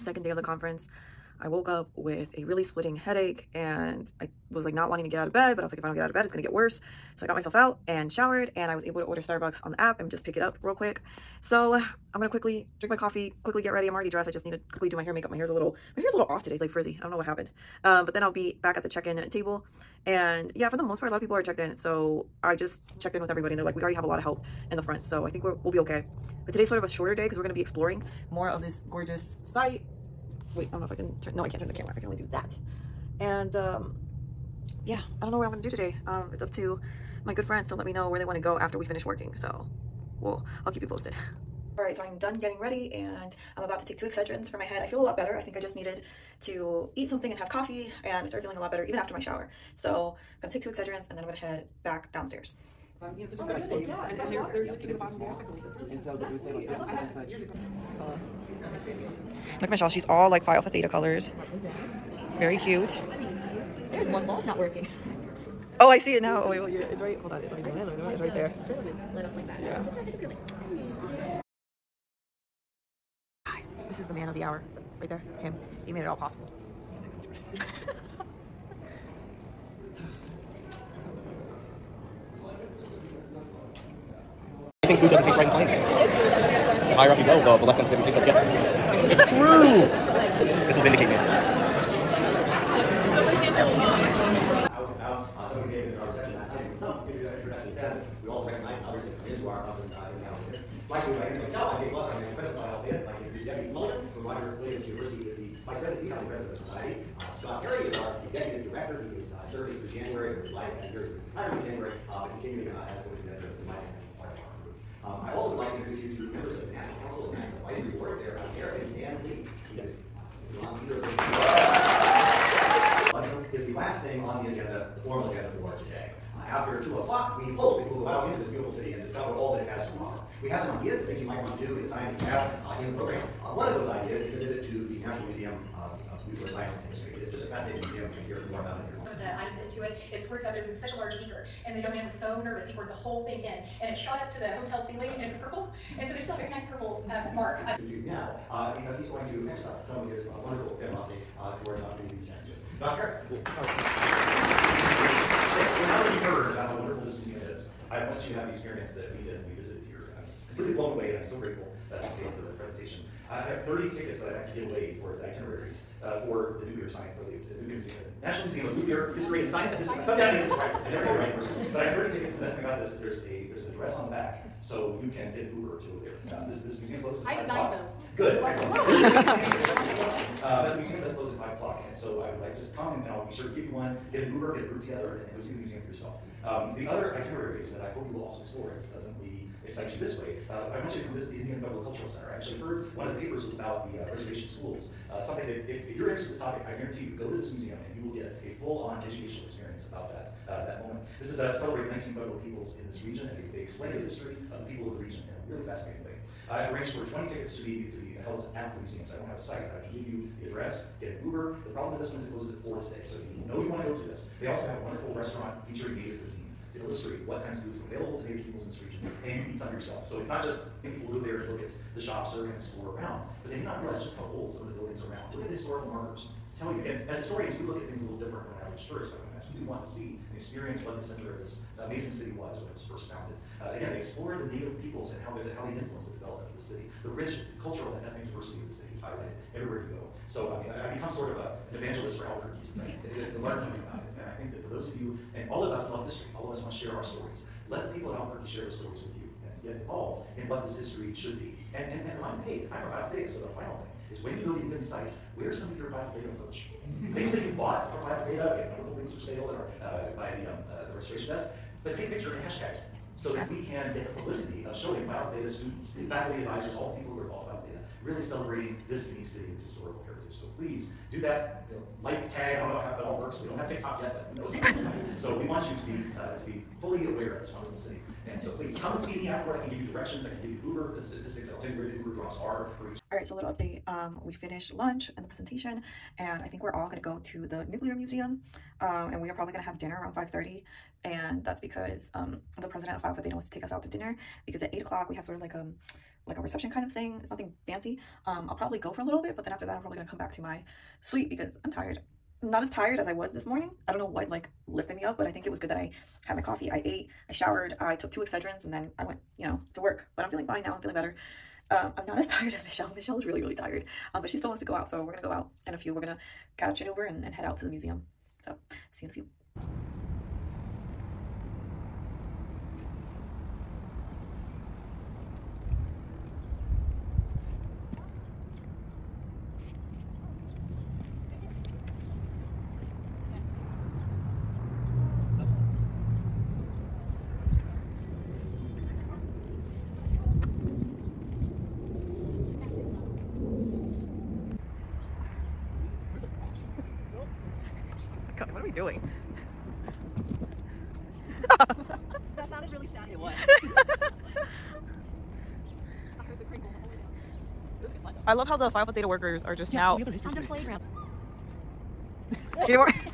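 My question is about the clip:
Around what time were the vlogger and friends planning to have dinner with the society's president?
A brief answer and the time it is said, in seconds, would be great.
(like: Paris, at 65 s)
5:30, at 290 s.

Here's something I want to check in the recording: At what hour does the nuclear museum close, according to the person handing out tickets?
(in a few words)
5 o'clock.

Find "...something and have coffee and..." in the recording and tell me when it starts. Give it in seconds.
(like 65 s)
47 s.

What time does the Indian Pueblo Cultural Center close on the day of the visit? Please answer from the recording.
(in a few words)
4.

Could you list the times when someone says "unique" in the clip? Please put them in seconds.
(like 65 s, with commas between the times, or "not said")
269 s.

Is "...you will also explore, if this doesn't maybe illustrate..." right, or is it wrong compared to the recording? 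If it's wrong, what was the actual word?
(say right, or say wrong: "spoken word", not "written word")
wrong: "excite", not "illustrate".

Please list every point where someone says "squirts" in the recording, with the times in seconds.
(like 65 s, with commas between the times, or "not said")
140 s.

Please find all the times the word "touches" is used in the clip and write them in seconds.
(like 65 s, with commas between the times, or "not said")
not said.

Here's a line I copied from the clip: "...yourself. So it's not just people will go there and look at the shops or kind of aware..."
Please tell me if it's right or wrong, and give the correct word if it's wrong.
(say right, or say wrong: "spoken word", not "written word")
wrong: "explore", not "aware".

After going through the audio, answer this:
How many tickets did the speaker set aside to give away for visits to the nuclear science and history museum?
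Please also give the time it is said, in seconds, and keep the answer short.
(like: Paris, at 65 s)
30, at 163 s.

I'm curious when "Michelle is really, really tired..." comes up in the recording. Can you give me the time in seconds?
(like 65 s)
312 s.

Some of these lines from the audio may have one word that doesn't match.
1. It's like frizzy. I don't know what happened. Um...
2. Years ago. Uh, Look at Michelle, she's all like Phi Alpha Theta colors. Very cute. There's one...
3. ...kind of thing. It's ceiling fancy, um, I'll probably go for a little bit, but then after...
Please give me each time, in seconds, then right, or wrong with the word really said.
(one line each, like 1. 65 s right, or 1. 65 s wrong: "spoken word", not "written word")
1. 16 s right
2. 57 s right
3. 296 s wrong: "nothing", not "ceiling".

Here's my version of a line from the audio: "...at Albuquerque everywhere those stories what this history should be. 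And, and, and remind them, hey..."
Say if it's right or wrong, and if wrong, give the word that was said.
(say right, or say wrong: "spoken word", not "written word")
wrong: "share", not "everywhere".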